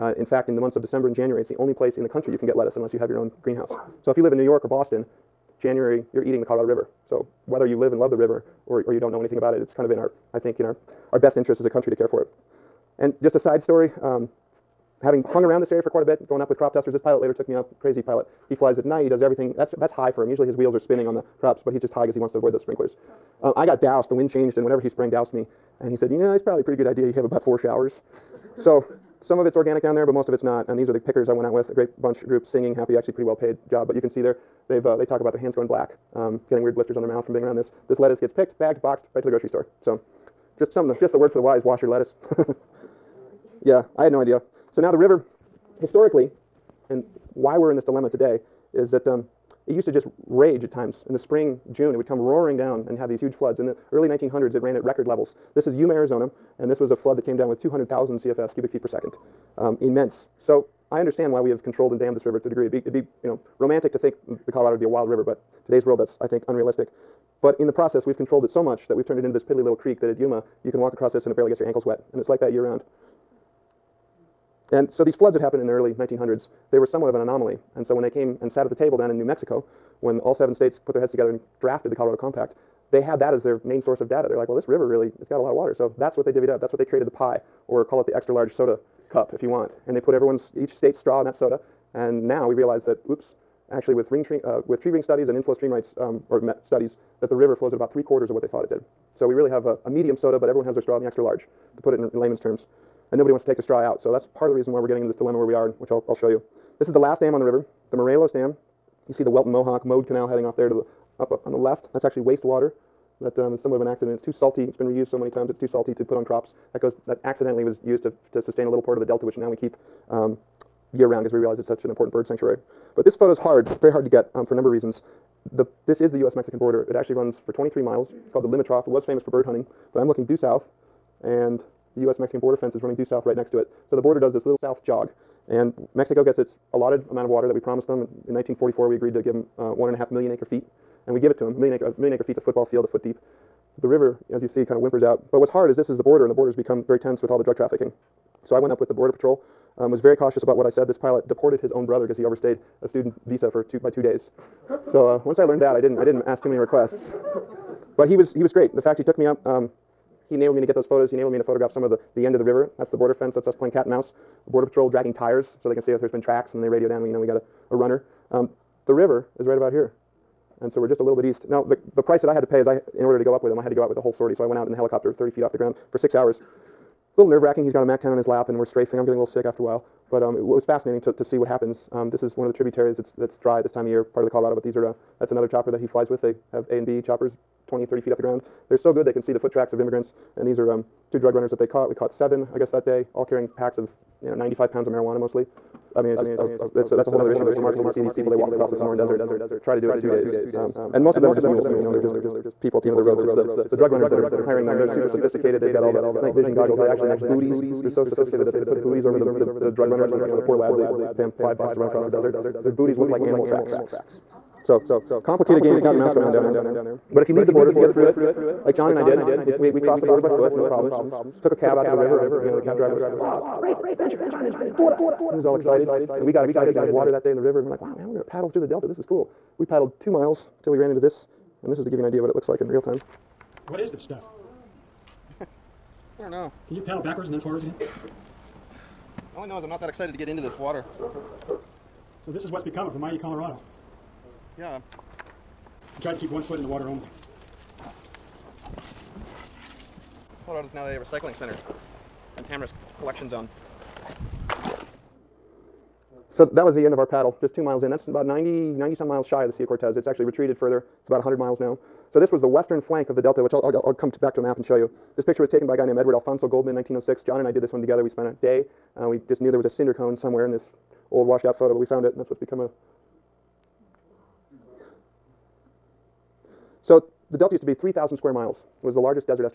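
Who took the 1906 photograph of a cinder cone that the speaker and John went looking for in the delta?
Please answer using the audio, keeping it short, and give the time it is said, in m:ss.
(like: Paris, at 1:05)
Edward Alphonso Goldman, at 4:25.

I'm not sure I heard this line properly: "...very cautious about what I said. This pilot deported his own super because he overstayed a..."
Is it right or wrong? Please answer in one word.
wrong.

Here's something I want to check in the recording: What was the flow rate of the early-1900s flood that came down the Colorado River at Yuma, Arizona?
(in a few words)
200,000 CFS.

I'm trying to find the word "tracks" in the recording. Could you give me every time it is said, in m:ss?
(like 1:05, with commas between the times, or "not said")
2:46, 3:09, 3:33.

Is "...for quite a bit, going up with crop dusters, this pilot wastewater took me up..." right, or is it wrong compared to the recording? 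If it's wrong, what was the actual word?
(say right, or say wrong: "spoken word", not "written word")
wrong: "later", not "wastewater".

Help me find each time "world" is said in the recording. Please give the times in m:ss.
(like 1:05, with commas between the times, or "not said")
1:05.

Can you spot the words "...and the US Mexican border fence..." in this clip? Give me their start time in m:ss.
2:11.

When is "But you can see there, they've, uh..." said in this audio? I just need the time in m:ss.
0:33.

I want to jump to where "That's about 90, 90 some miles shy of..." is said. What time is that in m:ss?
4:17.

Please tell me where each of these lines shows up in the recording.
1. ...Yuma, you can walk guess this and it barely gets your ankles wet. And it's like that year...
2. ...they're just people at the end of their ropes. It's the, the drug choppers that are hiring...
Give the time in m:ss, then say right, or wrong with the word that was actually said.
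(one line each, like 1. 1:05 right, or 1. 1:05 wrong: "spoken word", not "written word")
1. 1:10 wrong: "across", not "guess"
2. 3:21 wrong: "runners", not "choppers".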